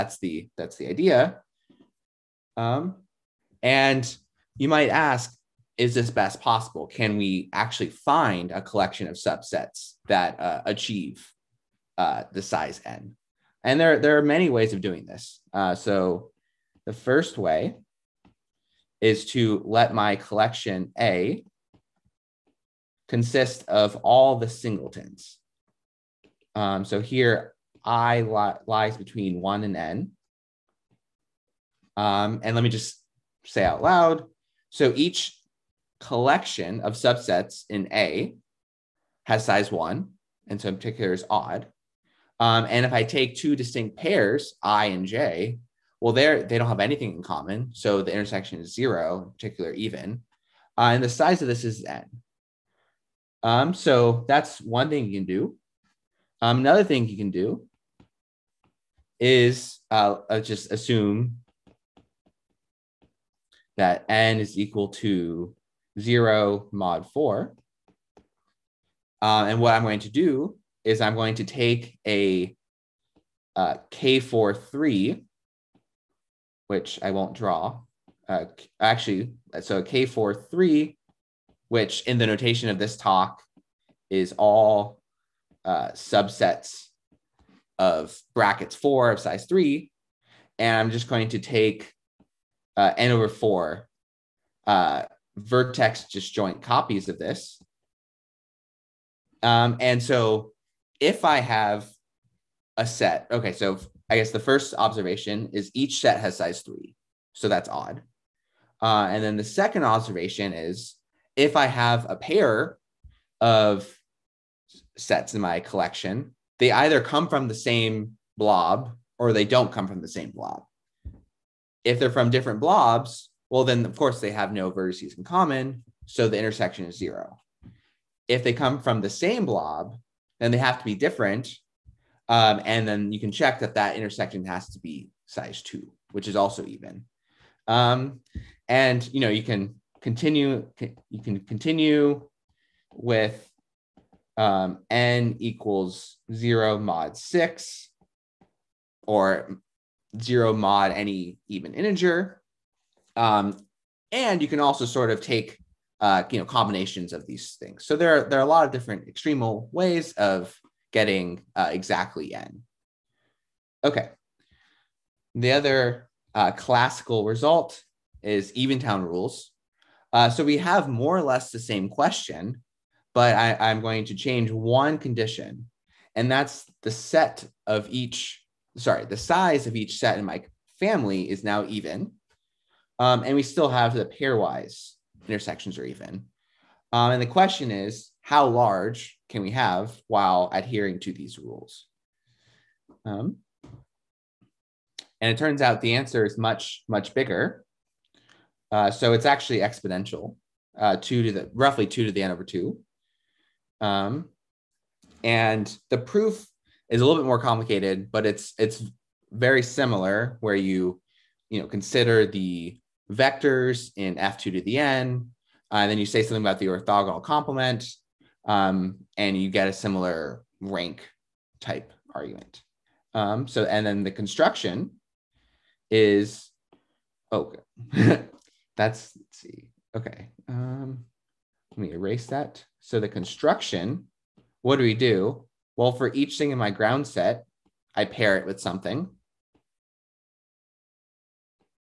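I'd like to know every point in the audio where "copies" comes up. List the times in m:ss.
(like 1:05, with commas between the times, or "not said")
1:36.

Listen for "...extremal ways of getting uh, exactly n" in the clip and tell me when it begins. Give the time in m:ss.
2:39.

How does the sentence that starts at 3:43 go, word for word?
Um, so and then the construction is okay.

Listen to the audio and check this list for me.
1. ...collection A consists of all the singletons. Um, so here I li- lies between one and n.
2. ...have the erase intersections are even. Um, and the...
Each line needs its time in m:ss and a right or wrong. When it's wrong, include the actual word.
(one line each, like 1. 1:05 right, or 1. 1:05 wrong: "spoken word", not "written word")
1. 0:20 right
2. 3:03 wrong: "pairwise", not "erase".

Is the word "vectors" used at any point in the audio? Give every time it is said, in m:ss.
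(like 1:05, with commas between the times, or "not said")
3:33.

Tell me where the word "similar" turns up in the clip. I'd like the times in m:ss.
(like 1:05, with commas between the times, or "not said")
3:29, 3:39.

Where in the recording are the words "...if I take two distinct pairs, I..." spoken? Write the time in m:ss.
0:42.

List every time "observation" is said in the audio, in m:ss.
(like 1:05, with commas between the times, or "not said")
1:44, 1:49.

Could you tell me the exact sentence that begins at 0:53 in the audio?
Um, so that's one thing you can do.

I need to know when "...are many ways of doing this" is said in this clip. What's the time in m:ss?
0:14.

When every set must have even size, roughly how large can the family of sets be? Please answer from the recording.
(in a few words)
2 to the n/2.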